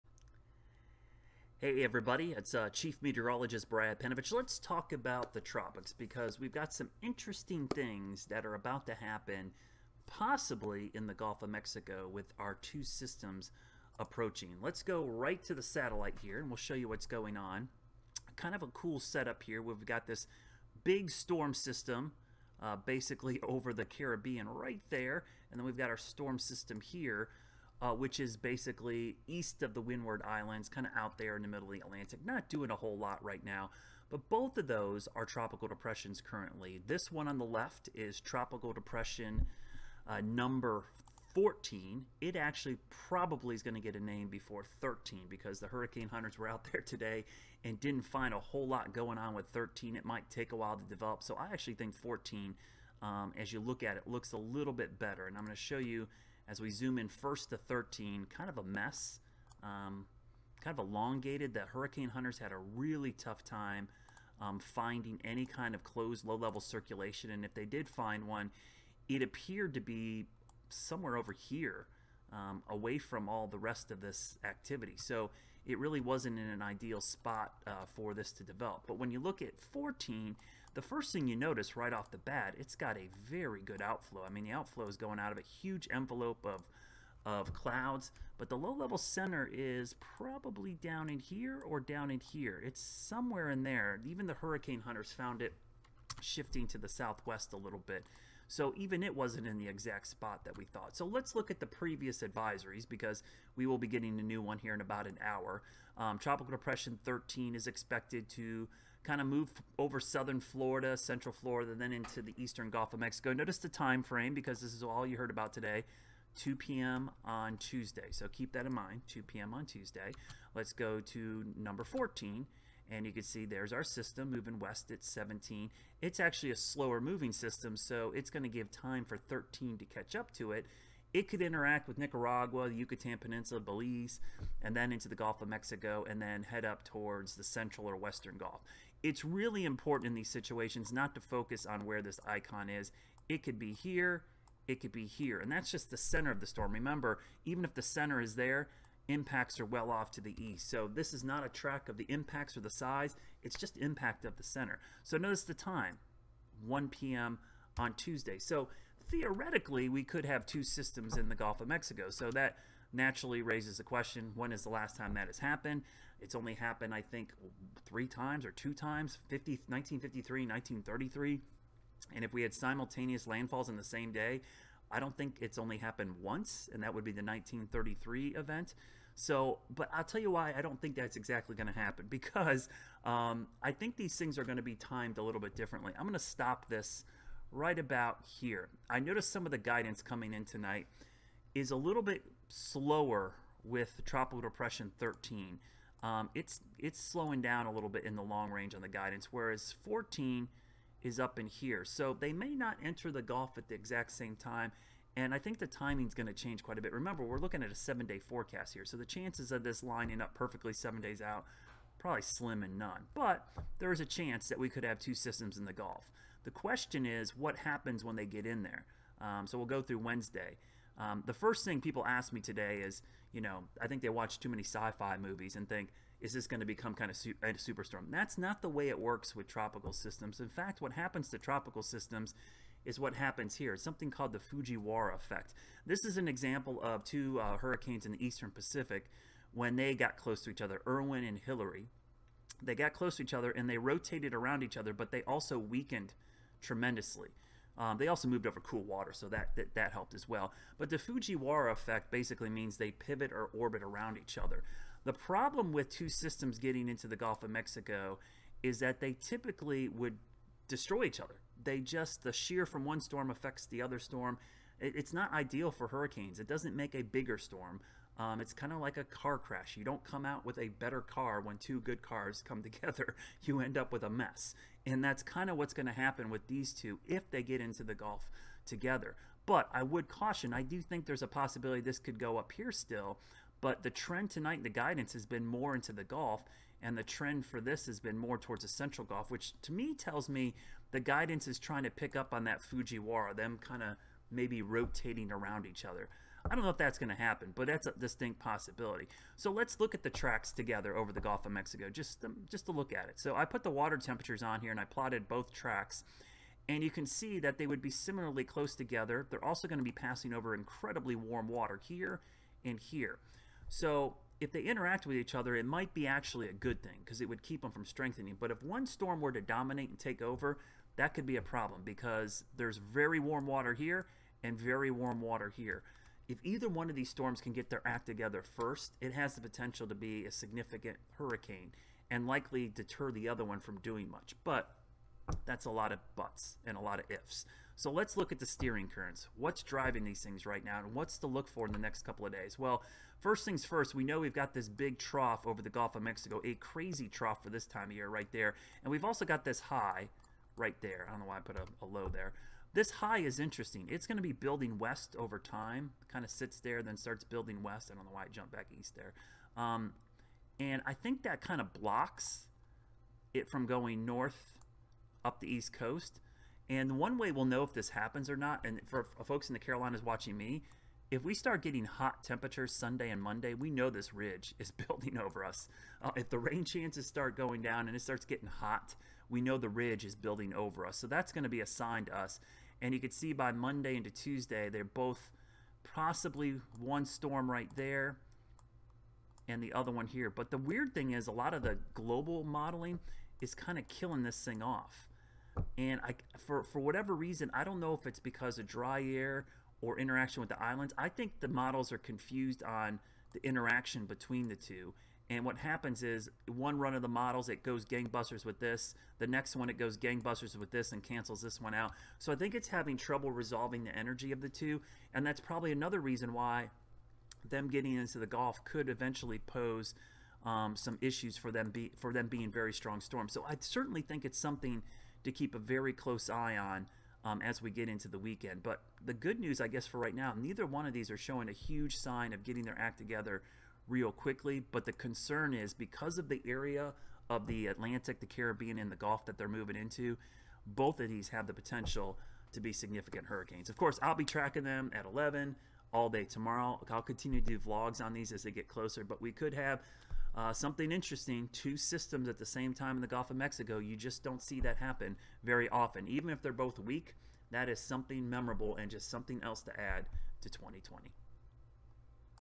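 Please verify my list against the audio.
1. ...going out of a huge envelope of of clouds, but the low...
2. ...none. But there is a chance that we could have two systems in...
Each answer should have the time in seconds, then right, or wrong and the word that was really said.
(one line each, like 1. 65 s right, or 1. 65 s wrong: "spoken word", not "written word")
1. 84 s right
2. 212 s right.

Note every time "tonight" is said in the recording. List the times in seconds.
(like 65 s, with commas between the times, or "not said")
190 s, 284 s.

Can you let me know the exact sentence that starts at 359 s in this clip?
Um, and I think that kind of blocks it from going north up the east coast.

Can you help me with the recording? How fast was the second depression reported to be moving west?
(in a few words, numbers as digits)
17.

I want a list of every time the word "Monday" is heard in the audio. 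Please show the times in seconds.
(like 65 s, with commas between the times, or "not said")
373 s, 383 s.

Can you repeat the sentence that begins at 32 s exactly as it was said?
Not doing a whole lot right now, but both of those are tropical depressions currently.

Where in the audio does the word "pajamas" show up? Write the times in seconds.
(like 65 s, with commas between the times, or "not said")
not said.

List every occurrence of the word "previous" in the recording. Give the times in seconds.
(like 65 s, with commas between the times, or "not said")
101 s.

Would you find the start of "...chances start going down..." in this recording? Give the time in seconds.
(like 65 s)
376 s.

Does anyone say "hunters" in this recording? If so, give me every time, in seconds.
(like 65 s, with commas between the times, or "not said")
46 s, 62 s, 94 s.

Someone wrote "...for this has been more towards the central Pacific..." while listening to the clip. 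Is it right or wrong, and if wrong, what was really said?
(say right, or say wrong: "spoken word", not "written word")
wrong: "Gulf", not "Pacific".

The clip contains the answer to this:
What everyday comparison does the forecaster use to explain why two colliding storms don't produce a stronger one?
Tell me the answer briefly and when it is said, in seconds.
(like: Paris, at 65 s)
car crash, at 269 s.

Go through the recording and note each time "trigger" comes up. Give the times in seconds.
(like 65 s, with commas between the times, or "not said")
not said.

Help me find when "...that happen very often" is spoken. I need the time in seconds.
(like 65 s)
454 s.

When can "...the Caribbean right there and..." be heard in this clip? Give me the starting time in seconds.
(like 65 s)
23 s.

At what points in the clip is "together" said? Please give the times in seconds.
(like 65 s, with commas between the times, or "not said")
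272 s, 278 s, 300 s, 308 s, 328 s, 432 s.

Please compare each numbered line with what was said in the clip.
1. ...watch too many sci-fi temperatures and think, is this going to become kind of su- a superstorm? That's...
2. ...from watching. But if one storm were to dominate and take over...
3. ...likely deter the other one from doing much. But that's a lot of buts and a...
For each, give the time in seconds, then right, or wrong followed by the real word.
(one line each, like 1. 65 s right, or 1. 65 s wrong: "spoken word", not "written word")
1. 224 s wrong: "movies", not "temperatures"
2. 317 s wrong: "strengthening", not "watching"
3. 332 s right.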